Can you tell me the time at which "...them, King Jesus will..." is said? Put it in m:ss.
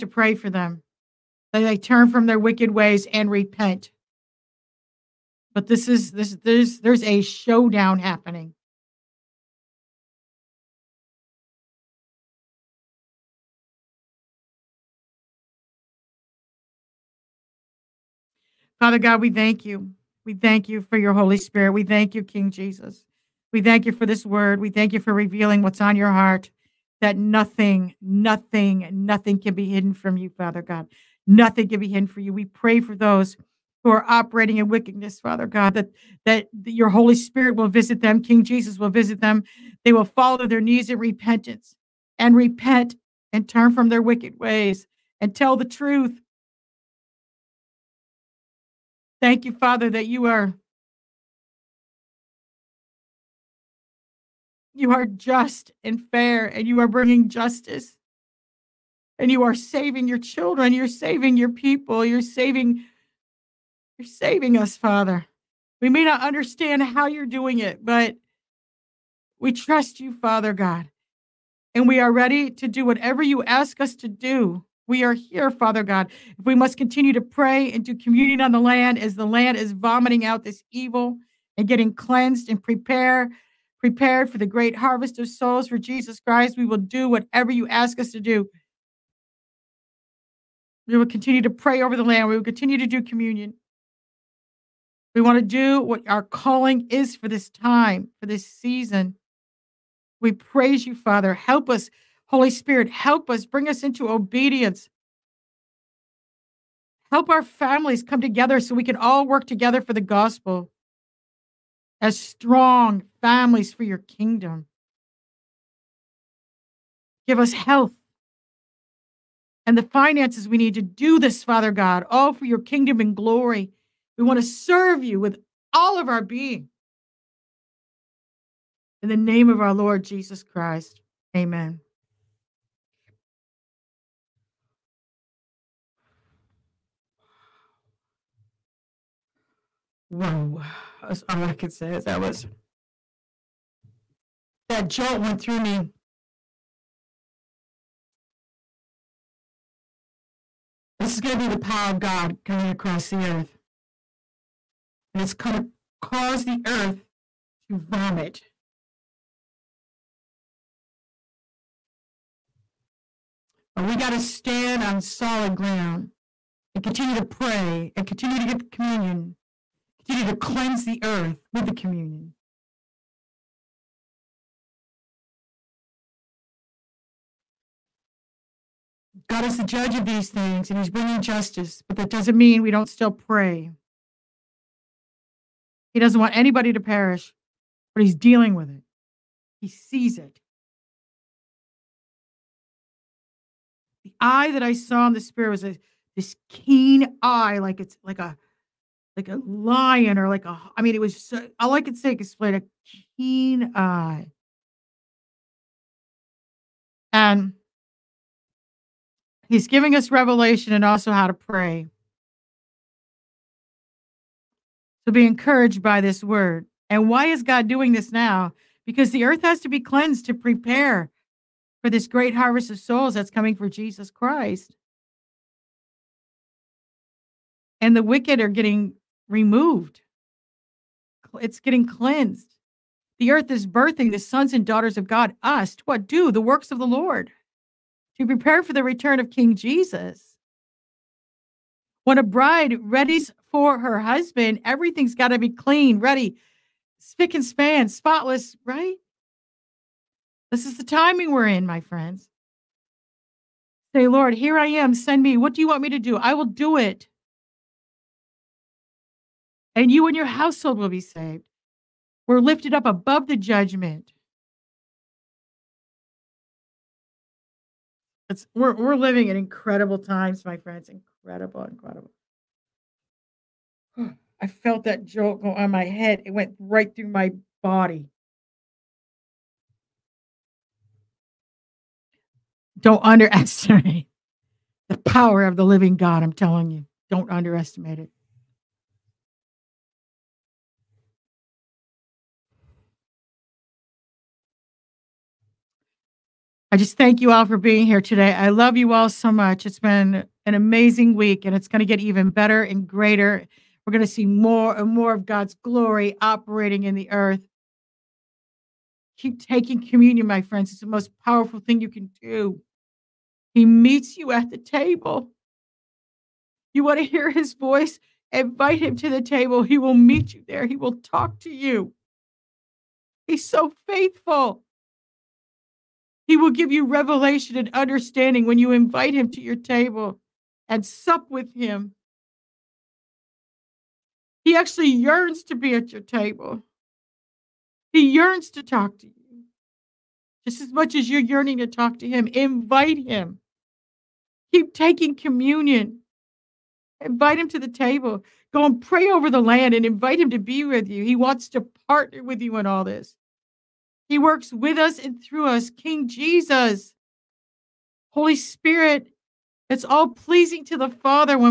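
0:38.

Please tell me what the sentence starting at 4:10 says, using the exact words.
This is the timing we're in, my friends.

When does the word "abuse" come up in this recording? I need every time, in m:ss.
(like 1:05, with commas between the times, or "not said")
not said.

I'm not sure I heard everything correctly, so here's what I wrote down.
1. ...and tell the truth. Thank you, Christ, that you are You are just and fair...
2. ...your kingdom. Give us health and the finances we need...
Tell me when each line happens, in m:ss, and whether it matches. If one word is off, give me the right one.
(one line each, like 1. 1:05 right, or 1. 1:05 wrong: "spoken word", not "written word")
1. 0:45 wrong: "Father", not "Christ"
2. 1:53 right.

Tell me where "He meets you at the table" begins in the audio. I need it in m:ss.
5:13.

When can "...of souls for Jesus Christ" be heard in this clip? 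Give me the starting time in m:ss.
1:25.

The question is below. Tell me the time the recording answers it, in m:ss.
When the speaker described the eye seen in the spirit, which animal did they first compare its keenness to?
3:19.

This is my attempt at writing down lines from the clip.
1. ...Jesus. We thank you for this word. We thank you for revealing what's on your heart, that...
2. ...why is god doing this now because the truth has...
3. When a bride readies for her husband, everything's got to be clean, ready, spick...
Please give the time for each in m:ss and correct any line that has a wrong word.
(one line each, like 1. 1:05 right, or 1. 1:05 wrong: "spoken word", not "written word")
1. 0:22 right
2. 3:37 wrong: "earth", not "truth"
3. 4:02 right.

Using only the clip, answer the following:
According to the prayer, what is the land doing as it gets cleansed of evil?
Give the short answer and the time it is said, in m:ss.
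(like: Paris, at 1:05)
Vomiting out, at 1:19.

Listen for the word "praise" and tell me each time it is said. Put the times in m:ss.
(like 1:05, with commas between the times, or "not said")
1:40.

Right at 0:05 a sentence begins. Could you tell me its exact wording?
But this is this there's there's a showdown happening.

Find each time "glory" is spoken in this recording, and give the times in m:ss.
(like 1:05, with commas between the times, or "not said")
2:03, 5:05.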